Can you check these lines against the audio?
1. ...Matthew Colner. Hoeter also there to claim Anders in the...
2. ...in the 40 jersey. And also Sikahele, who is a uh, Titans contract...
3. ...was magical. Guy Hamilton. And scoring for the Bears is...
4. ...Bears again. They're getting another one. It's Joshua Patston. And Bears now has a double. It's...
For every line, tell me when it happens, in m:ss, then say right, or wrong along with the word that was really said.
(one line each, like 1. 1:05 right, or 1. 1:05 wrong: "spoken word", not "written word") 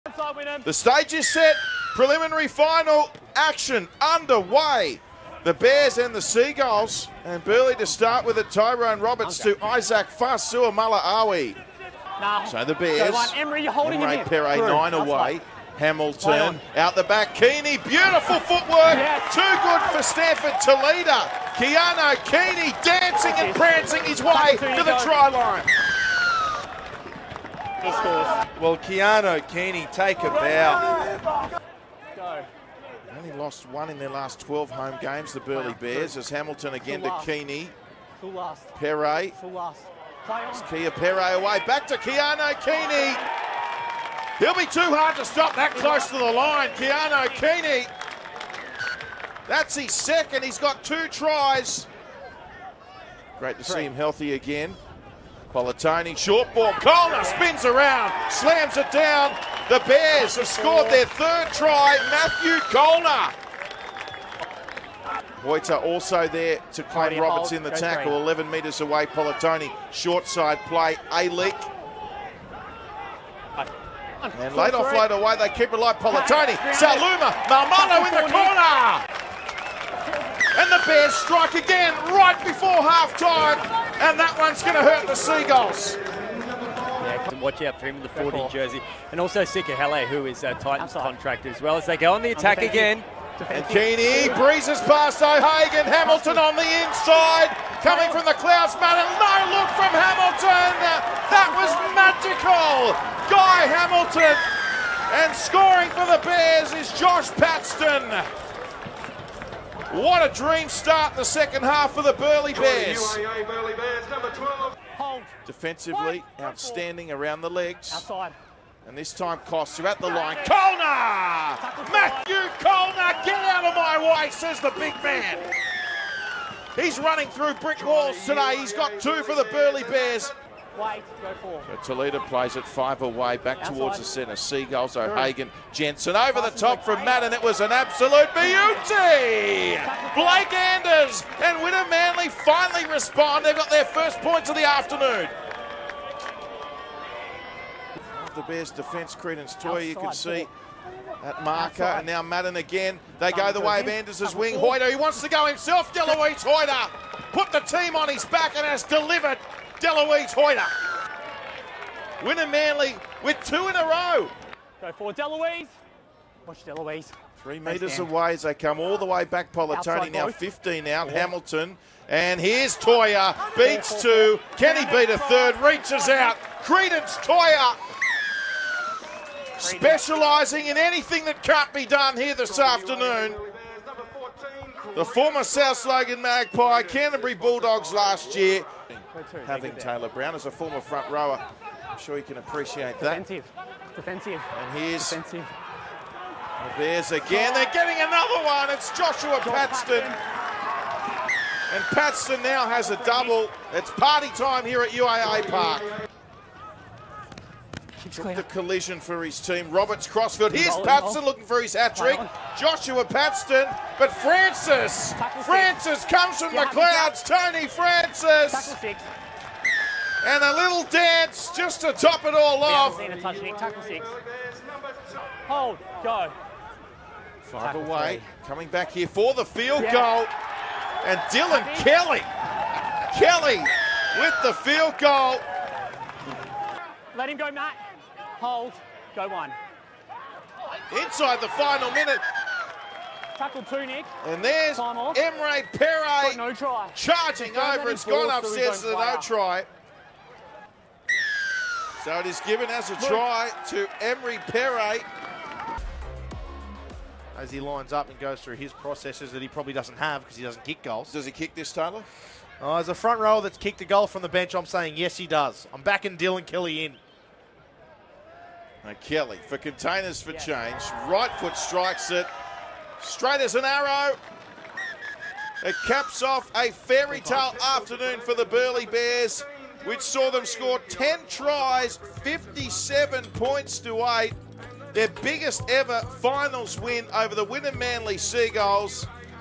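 1. 1:02 wrong: "Roberts", not "Anders"
2. 1:27 right
3. 1:41 right
4. 3:16 wrong: "Patston", not "Bears".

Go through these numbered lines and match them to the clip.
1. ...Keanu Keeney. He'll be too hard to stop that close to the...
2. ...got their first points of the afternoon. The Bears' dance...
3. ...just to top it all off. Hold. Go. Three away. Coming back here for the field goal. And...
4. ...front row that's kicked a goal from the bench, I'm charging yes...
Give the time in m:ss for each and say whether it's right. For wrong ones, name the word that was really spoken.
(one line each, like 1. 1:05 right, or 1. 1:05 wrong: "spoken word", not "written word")
1. 0:41 right
2. 2:23 wrong: "defence", not "dance"
3. 3:41 wrong: "Five", not "Three"
4. 4:22 wrong: "saying", not "charging".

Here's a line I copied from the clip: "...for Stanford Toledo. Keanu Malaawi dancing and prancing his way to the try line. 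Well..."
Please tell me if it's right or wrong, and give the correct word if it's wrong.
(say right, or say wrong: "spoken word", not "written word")
wrong: "Keeney", not "Malaawi".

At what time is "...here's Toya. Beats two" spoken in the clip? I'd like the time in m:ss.
2:52.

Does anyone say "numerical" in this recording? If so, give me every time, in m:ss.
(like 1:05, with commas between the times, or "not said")
not said.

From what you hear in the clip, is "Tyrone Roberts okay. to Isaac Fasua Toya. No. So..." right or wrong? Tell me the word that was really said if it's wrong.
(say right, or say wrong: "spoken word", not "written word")
wrong: "Malaawi", not "Toya".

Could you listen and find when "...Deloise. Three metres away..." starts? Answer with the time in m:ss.
2:46.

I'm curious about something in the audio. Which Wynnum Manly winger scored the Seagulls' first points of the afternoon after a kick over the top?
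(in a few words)
Blake Anders.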